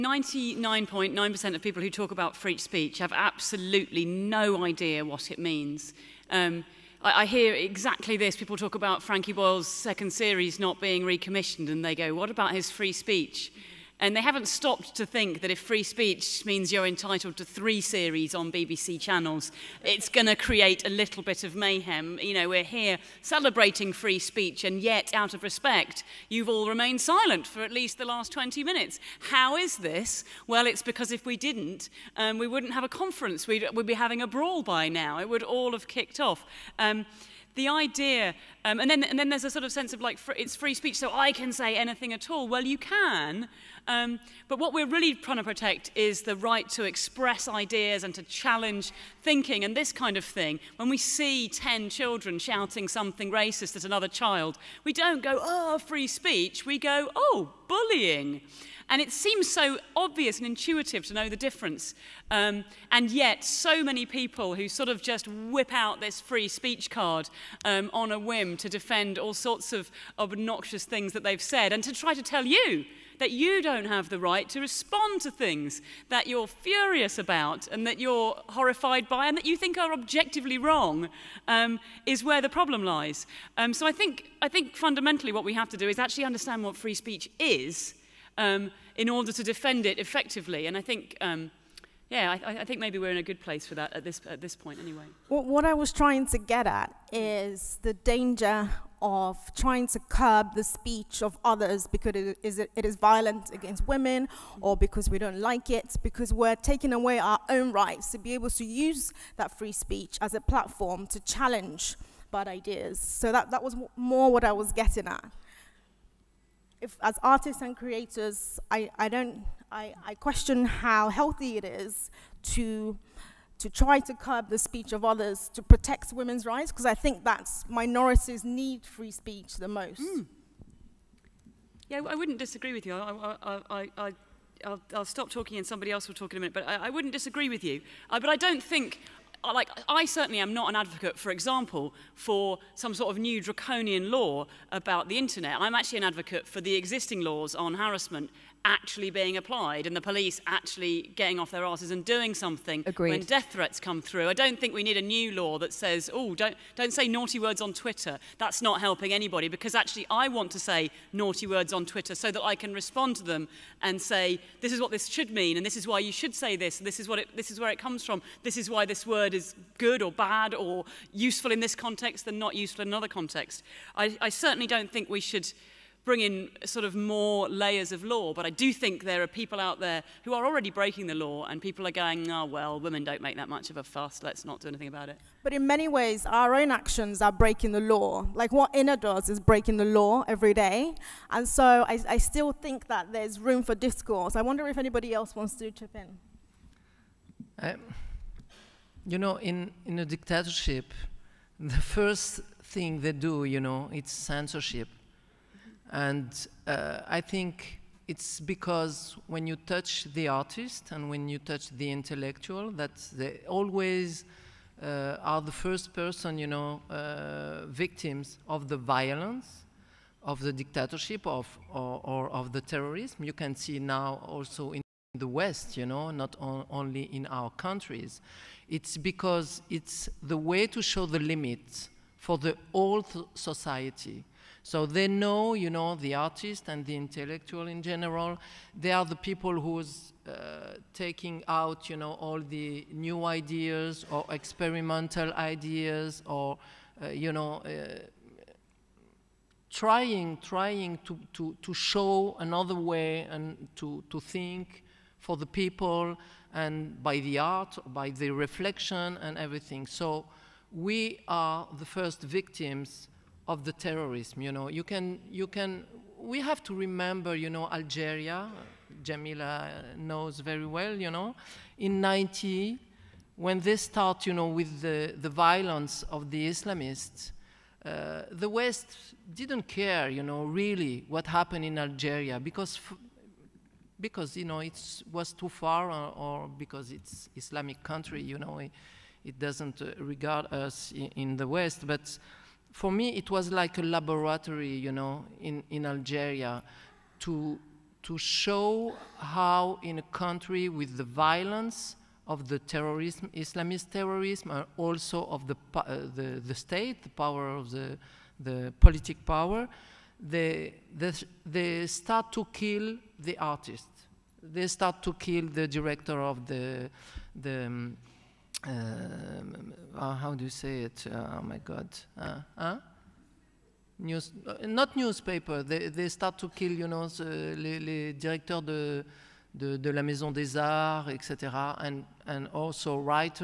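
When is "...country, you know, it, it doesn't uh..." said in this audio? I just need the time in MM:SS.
04:47.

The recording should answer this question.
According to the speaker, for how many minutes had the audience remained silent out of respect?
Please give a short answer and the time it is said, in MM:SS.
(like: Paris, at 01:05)
20, at 00:28.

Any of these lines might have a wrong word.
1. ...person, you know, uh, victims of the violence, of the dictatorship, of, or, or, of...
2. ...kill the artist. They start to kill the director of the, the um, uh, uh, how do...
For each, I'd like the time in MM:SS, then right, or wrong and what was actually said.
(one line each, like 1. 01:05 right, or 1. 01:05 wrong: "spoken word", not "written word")
1. 03:35 right
2. 05:12 right.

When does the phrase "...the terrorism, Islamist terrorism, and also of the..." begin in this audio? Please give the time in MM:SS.
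05:02.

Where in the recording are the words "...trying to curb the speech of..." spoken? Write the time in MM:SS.
01:39.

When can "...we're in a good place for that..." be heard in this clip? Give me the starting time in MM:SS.
01:32.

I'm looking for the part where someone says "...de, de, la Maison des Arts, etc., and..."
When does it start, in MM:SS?
05:29.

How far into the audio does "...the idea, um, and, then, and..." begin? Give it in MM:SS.
00:37.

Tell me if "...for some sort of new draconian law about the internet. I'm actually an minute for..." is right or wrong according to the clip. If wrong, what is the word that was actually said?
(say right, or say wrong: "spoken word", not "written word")
wrong: "advocate", not "minute".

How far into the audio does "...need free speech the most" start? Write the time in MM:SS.
02:08.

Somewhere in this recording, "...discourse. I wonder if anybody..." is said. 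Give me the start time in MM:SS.
03:13.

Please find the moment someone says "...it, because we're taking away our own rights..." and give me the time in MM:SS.
01:45.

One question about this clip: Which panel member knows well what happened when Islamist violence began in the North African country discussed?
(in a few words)
Jamila.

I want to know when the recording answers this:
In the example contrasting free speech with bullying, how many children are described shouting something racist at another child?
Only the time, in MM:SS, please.
00:51.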